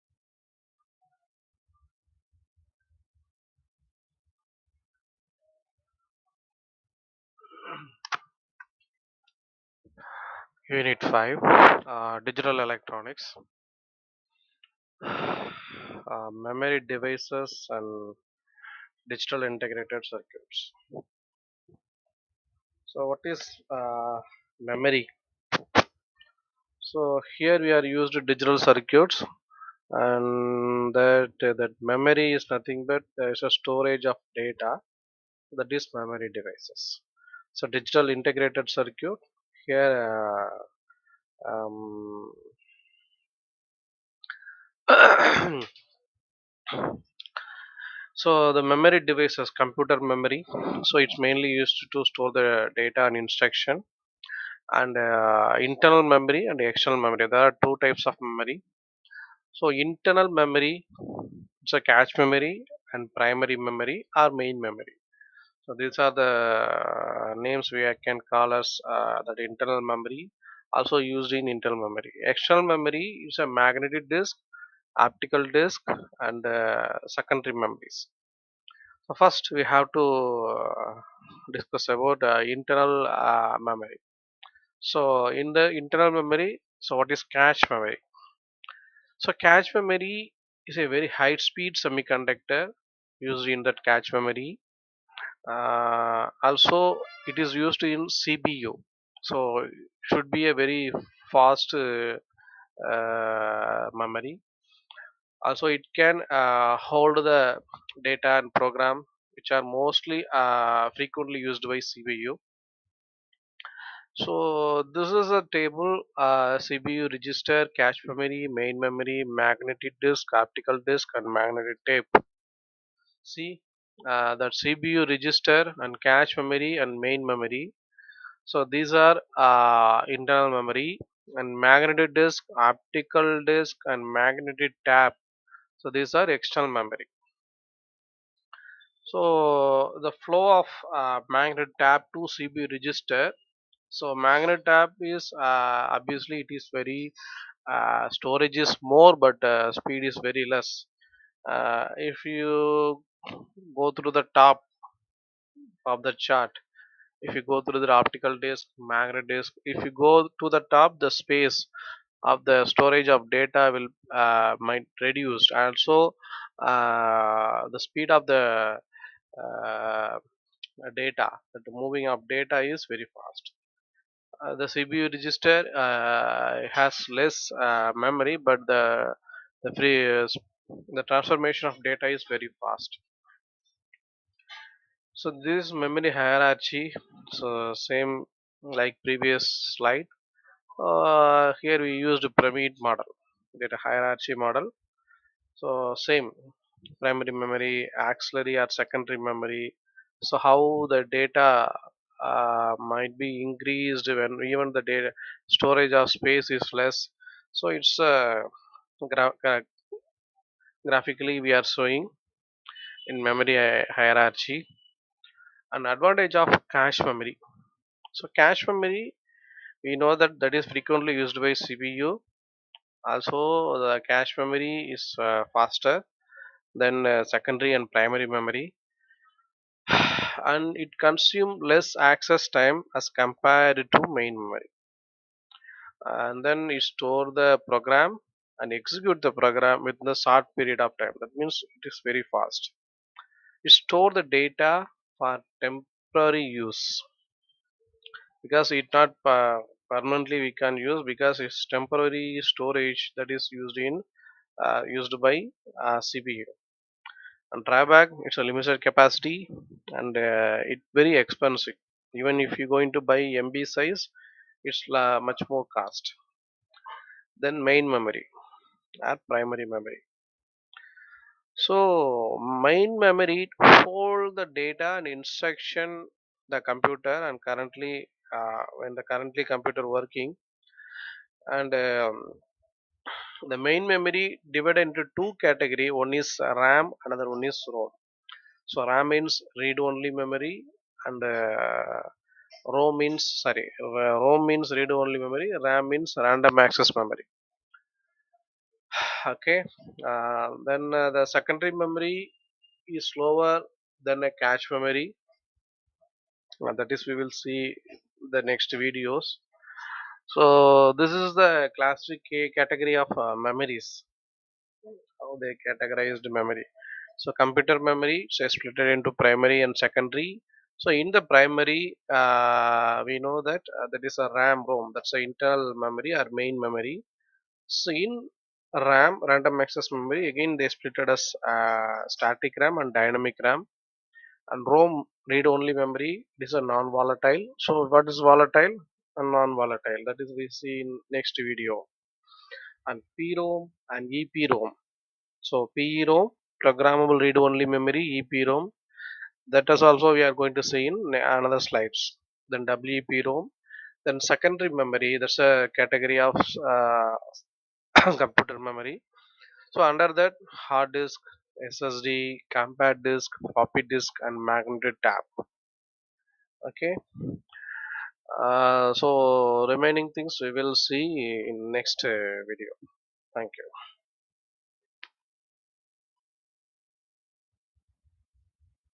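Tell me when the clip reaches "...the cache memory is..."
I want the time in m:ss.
3:43.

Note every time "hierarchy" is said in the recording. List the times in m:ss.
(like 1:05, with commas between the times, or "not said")
3:06, 3:13, 3:34.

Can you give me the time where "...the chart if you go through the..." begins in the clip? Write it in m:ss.
2:36.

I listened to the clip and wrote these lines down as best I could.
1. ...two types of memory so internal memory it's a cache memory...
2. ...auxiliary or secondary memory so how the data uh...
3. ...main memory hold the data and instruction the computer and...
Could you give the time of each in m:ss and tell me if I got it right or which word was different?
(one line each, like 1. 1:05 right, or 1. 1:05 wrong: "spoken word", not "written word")
1. 0:57 right
2. 3:18 right
3. 4:32 right.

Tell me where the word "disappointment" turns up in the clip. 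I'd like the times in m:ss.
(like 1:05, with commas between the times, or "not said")
not said.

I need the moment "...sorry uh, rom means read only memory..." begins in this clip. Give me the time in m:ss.
4:53.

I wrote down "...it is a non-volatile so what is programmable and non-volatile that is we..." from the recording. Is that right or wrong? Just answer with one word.
wrong.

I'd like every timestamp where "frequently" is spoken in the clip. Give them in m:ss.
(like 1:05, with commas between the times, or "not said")
1:50, 3:40.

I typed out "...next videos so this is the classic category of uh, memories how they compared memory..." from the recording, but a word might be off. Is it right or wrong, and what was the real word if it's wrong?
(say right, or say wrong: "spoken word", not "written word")
wrong: "categorized", not "compared".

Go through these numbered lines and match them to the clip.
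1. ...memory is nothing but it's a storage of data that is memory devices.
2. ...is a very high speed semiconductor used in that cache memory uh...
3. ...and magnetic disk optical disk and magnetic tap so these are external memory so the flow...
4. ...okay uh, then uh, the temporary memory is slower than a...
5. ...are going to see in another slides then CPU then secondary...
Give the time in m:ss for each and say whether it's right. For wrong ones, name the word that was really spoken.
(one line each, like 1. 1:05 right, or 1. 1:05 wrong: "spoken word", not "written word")
1. 0:31 right
2. 1:30 right
3. 2:11 right
4. 4:59 wrong: "secondary", not "temporary"
5. 5:50 wrong: "EEPROM", not "CPU".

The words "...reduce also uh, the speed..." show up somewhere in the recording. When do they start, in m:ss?
2:44.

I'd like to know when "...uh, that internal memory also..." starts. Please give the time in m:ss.
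1:08.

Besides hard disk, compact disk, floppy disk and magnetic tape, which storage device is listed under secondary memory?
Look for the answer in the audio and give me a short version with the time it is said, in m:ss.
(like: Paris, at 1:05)
SSD, at 6:01.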